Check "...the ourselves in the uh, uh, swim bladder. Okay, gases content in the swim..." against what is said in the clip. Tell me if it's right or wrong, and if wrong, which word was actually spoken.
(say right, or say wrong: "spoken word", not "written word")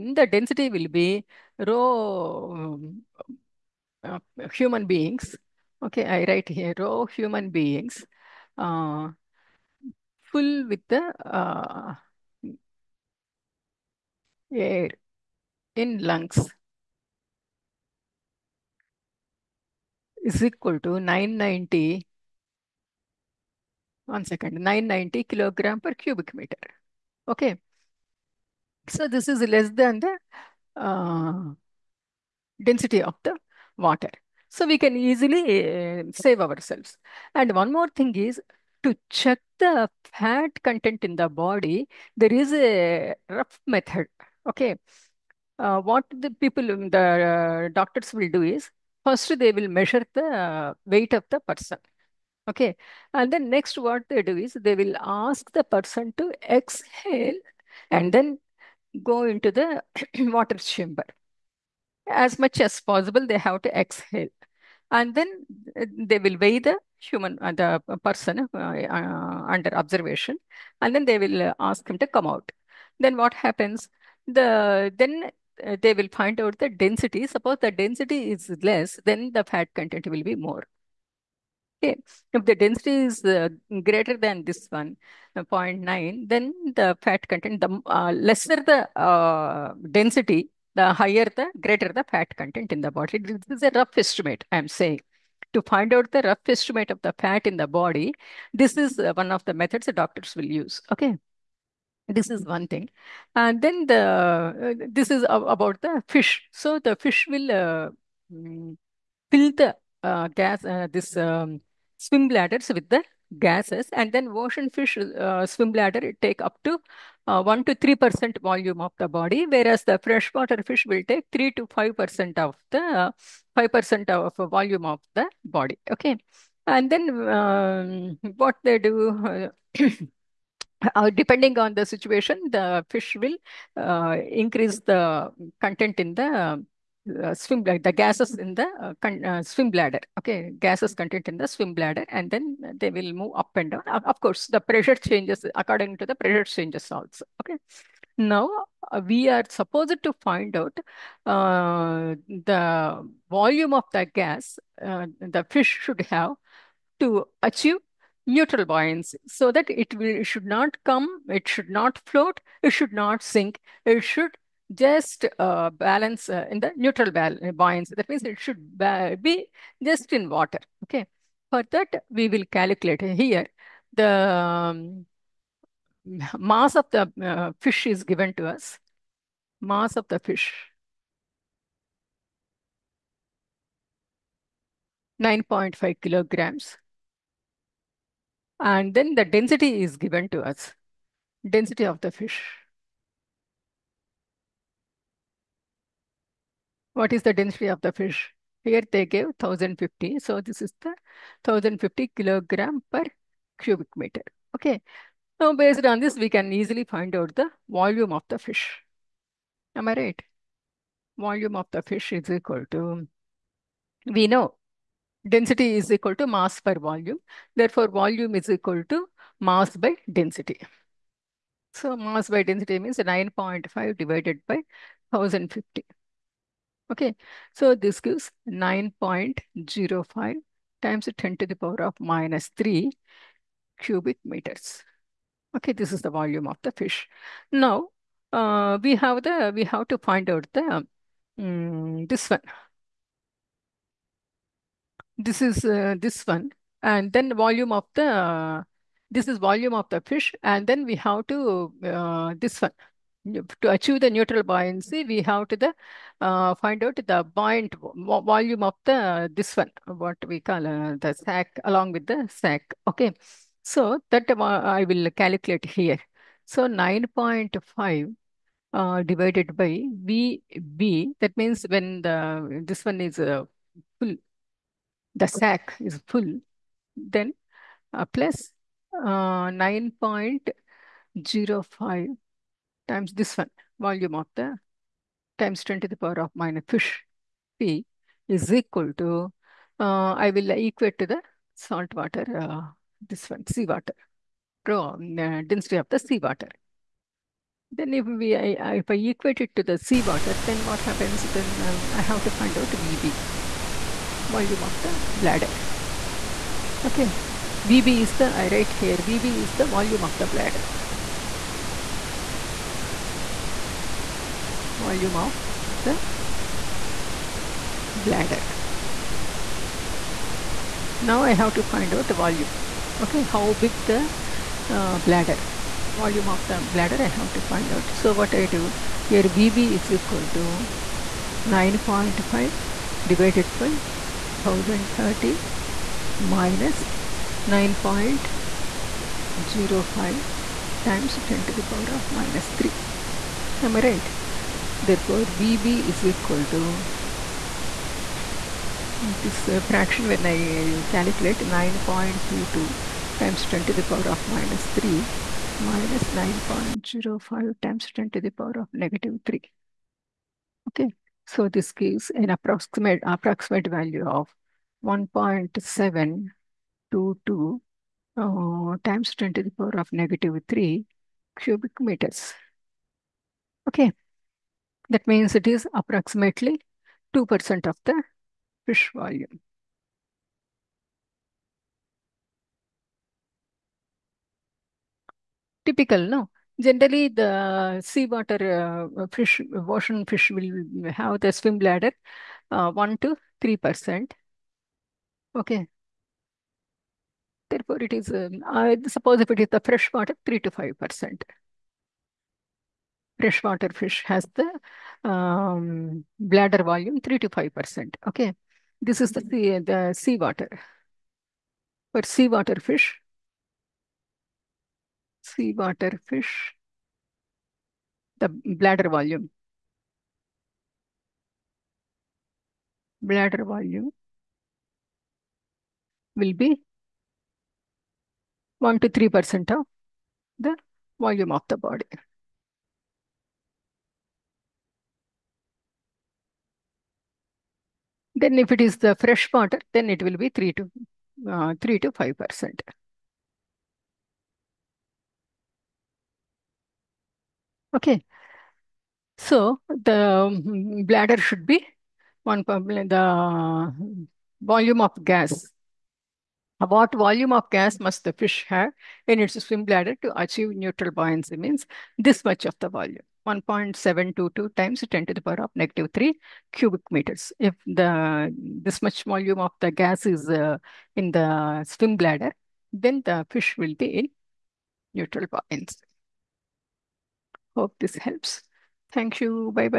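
wrong: "gases", not "ourselves".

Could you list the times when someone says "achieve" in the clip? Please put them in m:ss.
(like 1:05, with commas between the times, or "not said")
2:37, 4:13, 7:40.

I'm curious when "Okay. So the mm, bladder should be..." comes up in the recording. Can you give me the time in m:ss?
7:27.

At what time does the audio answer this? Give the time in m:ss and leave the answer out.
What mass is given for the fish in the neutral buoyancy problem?
3:05.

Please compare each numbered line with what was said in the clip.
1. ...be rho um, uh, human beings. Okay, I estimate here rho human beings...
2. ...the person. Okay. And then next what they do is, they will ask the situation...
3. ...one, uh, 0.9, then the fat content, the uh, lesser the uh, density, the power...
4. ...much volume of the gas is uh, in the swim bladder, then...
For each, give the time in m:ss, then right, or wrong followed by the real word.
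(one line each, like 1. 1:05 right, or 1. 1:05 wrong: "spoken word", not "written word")
1. 0:00 wrong: "write", not "estimate"
2. 0:51 wrong: "person", not "situation"
3. 1:24 wrong: "higher", not "power"
4. 7:48 right.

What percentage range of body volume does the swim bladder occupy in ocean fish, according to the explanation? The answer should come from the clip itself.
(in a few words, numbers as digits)
1 to 3 percent.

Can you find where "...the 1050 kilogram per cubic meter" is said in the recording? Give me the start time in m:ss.
3:20.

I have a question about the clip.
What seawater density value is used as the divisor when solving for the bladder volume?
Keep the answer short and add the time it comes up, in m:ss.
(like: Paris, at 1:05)
1030, at 5:34.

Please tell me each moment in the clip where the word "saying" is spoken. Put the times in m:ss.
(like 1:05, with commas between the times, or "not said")
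1:34.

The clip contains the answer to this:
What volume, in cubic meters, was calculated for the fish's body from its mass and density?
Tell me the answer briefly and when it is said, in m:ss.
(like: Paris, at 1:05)
9.05 × 10^-3, at 3:48.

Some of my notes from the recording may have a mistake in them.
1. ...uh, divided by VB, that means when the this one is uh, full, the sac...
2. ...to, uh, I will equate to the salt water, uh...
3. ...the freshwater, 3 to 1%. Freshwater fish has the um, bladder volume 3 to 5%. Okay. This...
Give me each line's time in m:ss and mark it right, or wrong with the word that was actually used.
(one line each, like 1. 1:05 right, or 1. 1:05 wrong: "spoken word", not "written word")
1. 4:28 right
2. 4:48 right
3. 6:39 wrong: "5", not "1".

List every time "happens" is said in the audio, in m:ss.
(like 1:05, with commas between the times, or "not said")
1:13, 5:00.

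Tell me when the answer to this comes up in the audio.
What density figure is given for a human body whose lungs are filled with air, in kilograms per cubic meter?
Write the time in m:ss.
0:24.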